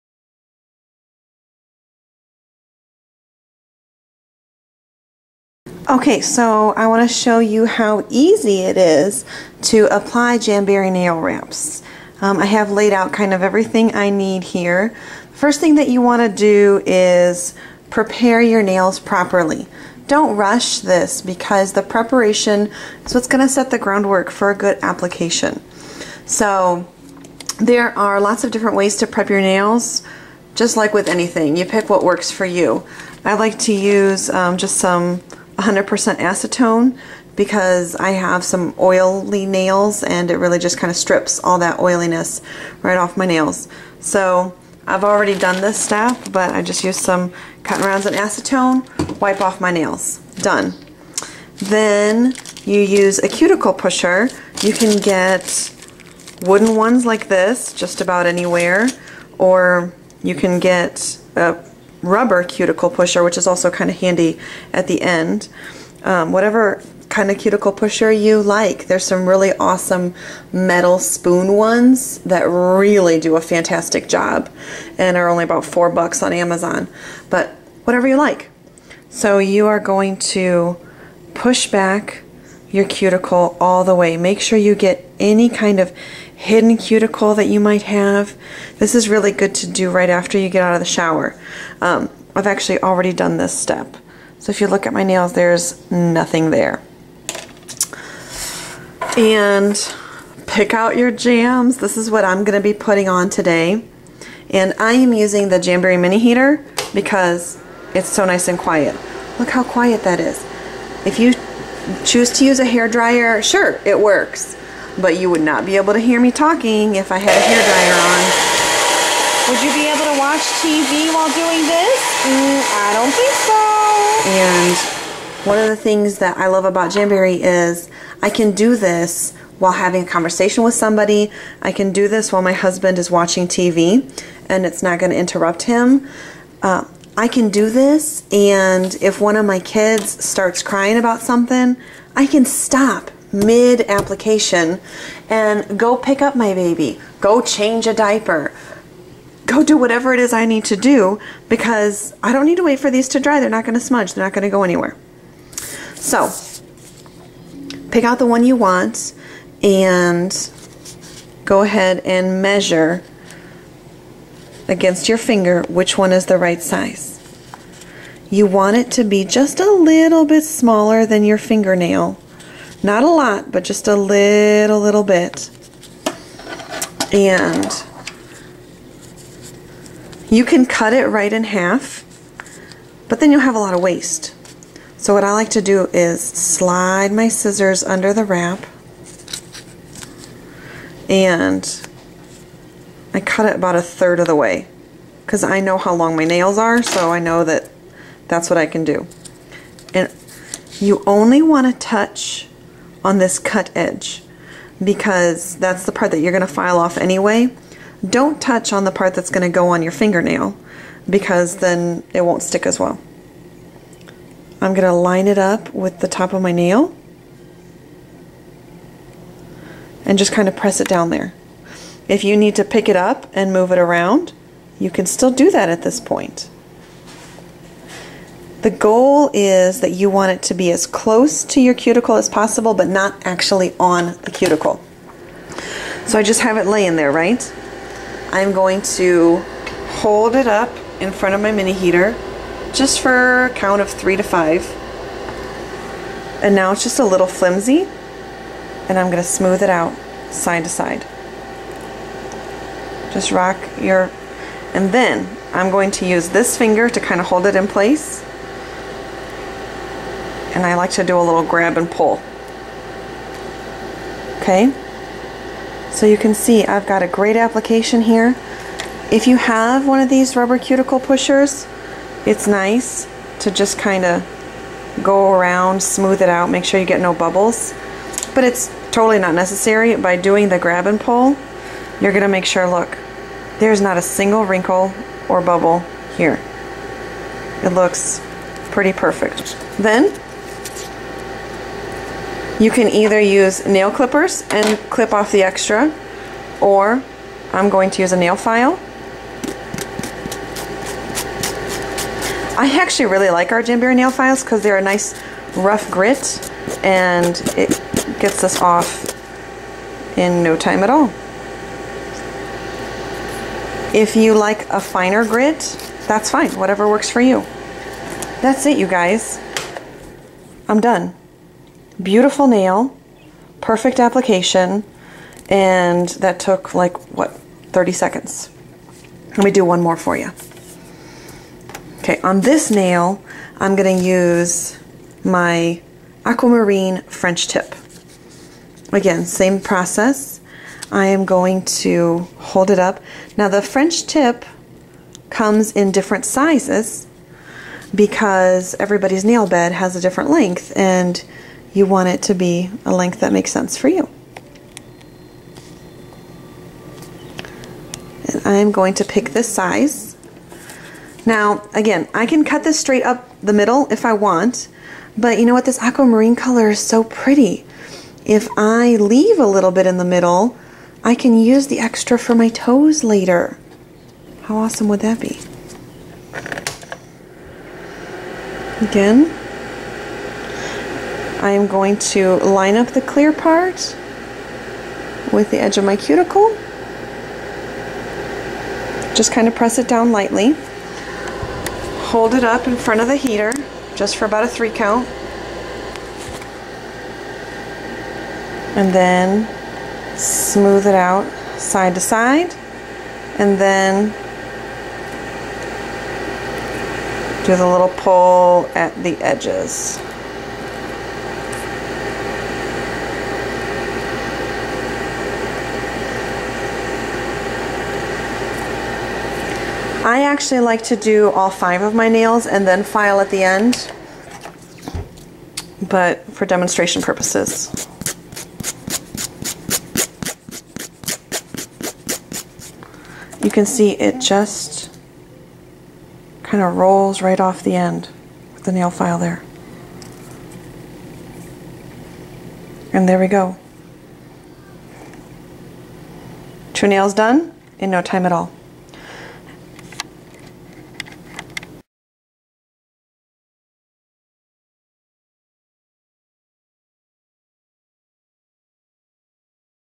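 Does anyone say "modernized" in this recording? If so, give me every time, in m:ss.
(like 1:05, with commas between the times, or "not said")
not said.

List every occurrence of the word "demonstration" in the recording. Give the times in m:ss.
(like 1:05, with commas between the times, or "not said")
7:06.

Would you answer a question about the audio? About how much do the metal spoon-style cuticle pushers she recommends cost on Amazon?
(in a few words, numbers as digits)
$4.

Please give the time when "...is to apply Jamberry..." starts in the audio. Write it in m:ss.
0:08.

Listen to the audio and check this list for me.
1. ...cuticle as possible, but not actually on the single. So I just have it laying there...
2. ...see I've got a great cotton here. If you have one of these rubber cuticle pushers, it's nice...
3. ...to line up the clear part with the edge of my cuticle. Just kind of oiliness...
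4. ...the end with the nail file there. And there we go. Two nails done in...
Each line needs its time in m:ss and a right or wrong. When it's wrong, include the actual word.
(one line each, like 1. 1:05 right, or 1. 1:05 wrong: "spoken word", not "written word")
1. 3:51 wrong: "cuticle", not "single"
2. 4:26 wrong: "application", not "cotton"
3. 6:21 wrong: "press", not "oiliness"
4. 7:17 right.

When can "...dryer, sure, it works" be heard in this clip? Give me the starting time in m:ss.
1:52.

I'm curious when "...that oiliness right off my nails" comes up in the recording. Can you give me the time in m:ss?
0:41.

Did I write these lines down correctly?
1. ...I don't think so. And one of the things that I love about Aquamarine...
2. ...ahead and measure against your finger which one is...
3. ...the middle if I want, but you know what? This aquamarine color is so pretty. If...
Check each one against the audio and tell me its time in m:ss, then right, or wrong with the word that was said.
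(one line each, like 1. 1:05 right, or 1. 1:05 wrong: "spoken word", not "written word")
1. 2:02 wrong: "Jamberry", not "Aquamarine"
2. 2:41 right
3. 6:03 right.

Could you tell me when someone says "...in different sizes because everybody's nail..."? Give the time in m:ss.
5:45.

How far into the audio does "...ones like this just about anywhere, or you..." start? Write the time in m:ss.
0:56.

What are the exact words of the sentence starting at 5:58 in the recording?
And I'm going to pick this size.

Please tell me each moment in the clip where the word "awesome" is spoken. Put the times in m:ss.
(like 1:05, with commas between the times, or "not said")
1:09, 6:14.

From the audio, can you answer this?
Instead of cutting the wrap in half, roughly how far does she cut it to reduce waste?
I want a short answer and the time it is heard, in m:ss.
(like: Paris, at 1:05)
a third of the way, at 3:13.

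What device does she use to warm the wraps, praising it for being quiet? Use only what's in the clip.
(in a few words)
Jamberry Mini Heater.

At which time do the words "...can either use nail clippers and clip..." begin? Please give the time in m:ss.
4:52.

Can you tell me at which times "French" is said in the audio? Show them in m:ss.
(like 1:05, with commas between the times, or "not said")
5:37, 5:43.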